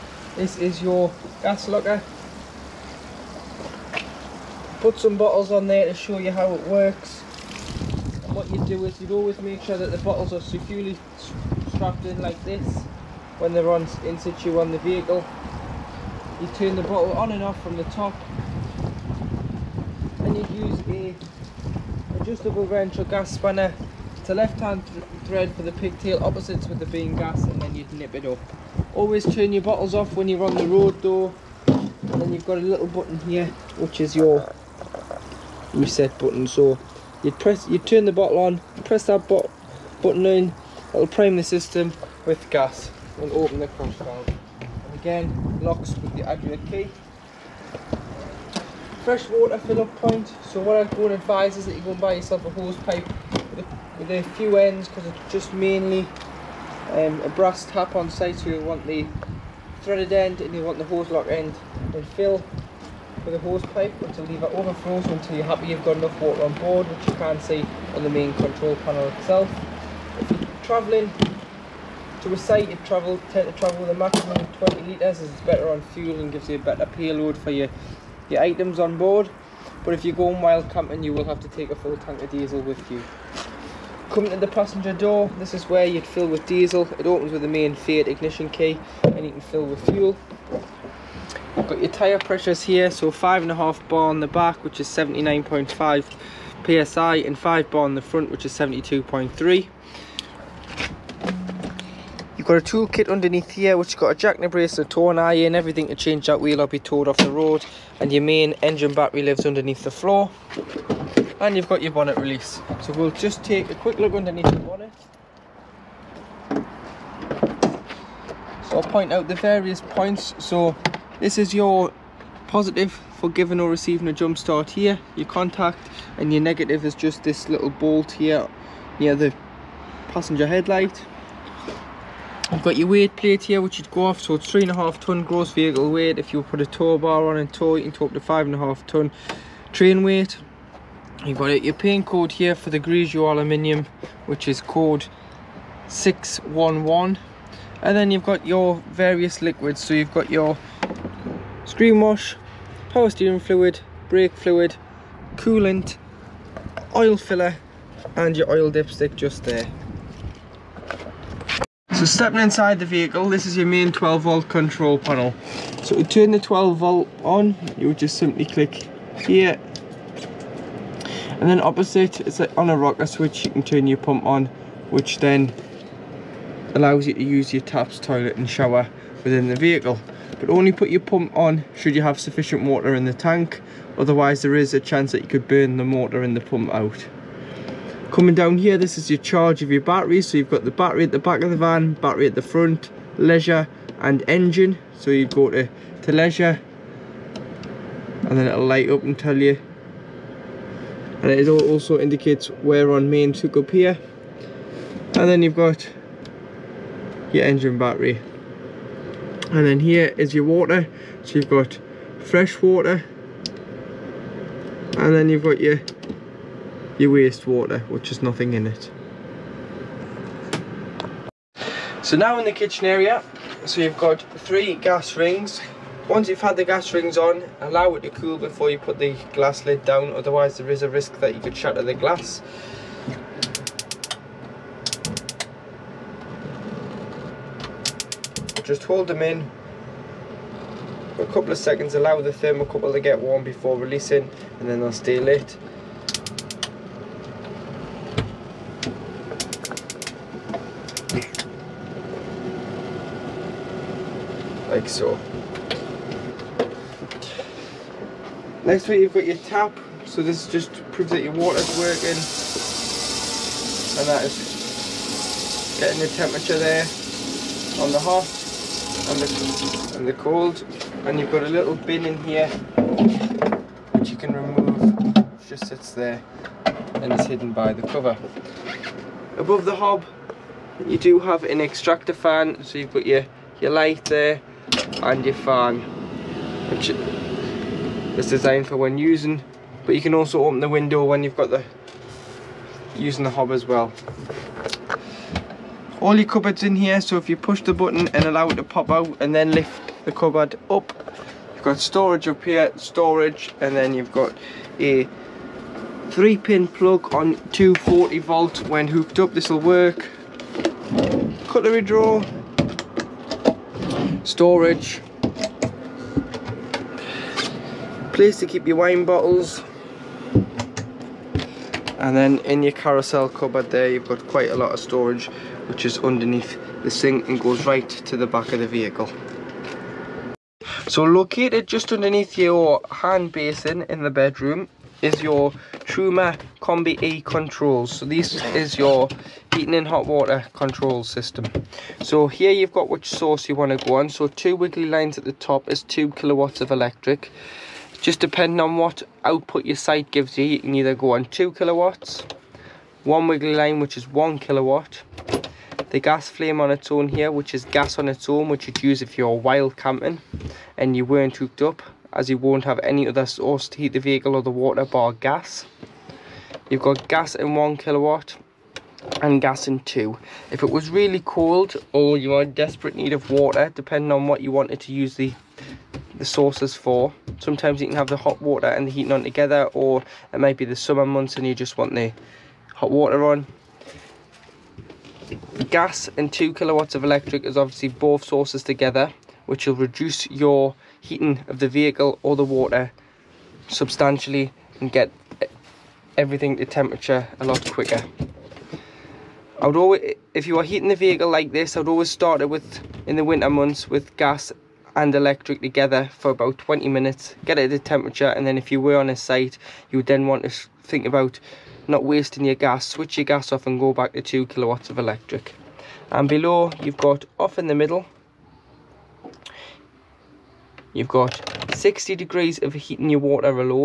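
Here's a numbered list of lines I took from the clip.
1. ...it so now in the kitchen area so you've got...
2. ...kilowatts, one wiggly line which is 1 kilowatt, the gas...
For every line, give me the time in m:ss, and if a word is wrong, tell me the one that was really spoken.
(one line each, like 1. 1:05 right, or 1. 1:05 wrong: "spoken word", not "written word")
1. 3:38 right
2. 5:51 right.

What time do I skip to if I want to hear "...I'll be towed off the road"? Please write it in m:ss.
1:46.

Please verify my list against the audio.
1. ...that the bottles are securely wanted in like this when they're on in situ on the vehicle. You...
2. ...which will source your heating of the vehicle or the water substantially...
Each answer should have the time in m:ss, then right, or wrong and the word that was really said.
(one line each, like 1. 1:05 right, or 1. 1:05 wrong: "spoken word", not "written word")
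1. 0:09 wrong: "strapped", not "wanted"
2. 6:29 wrong: "reduce", not "source".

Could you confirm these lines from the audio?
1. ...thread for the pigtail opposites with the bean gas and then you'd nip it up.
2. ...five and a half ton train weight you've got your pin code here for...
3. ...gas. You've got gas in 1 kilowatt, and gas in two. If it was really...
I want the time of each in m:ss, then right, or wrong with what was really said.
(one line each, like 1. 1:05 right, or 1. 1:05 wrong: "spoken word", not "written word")
1. 0:25 right
2. 2:18 right
3. 6:05 right.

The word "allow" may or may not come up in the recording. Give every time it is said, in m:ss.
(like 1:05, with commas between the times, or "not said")
2:56, 3:47, 4:01, 4:58.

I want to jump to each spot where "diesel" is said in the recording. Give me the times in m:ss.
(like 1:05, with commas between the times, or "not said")
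1:22, 1:26.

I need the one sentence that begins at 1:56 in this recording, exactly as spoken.
So I'll point out the various points.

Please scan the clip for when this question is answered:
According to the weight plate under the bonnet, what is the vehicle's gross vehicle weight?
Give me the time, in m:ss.
2:14.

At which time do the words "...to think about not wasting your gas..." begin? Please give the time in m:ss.
6:50.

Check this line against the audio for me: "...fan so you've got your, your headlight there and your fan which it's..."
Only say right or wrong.
wrong.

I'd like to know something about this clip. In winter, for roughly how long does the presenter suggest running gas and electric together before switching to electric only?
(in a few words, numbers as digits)
20 minutes.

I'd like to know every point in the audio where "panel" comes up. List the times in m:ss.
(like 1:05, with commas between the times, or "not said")
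1:08, 2:44.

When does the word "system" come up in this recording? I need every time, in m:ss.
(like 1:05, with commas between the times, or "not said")
0:41, 5:41.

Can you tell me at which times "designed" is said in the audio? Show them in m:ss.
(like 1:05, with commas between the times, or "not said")
4:48.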